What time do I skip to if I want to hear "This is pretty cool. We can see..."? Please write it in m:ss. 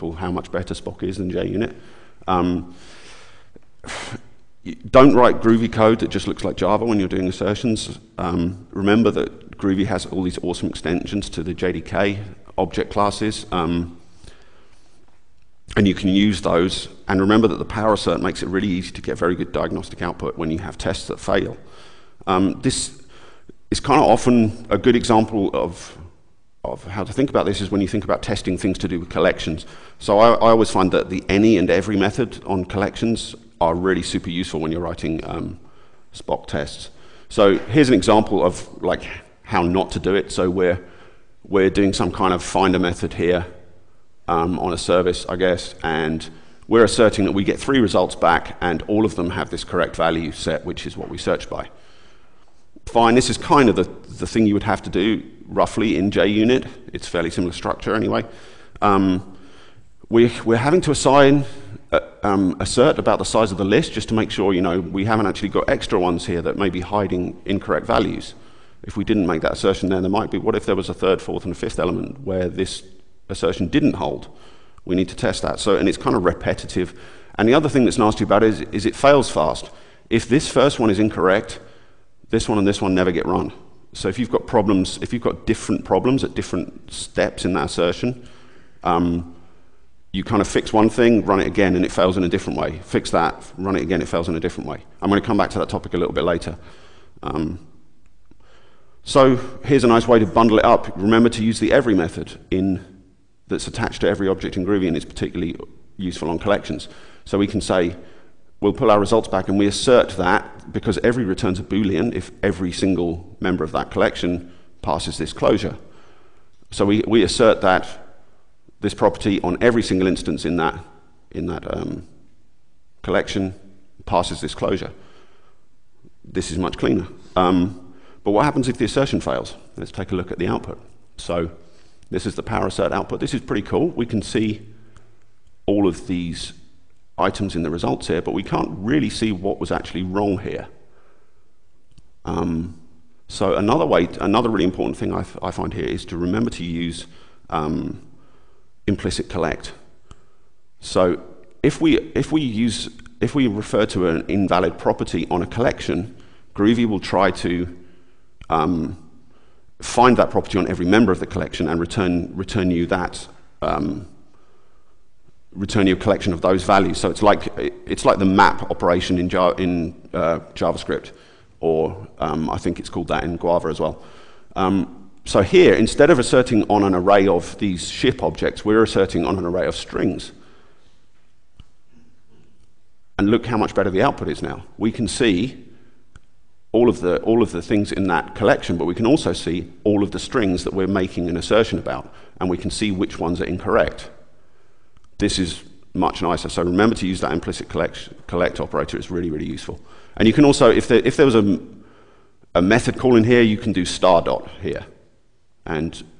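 2:13.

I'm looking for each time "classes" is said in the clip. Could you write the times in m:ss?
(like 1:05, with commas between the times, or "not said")
0:12.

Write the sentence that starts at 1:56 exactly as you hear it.
So we, we assert that this property on every single instance in that, in that um, collection passes this closure.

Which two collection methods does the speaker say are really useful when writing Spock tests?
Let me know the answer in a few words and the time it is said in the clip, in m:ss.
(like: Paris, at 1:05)
any and every, at 0:31.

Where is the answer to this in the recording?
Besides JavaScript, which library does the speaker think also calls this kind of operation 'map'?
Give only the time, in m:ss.
2:53.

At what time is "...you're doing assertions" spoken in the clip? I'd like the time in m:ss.
0:06.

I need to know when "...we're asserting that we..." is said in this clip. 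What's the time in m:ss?
0:46.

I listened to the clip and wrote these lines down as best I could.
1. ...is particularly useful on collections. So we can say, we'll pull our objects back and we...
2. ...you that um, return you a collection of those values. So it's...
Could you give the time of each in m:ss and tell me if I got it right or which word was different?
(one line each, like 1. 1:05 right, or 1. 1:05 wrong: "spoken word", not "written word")
1. 1:44 wrong: "results", not "objects"
2. 2:42 right.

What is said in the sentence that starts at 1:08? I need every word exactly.
If we didn't make that assertion, then there might be.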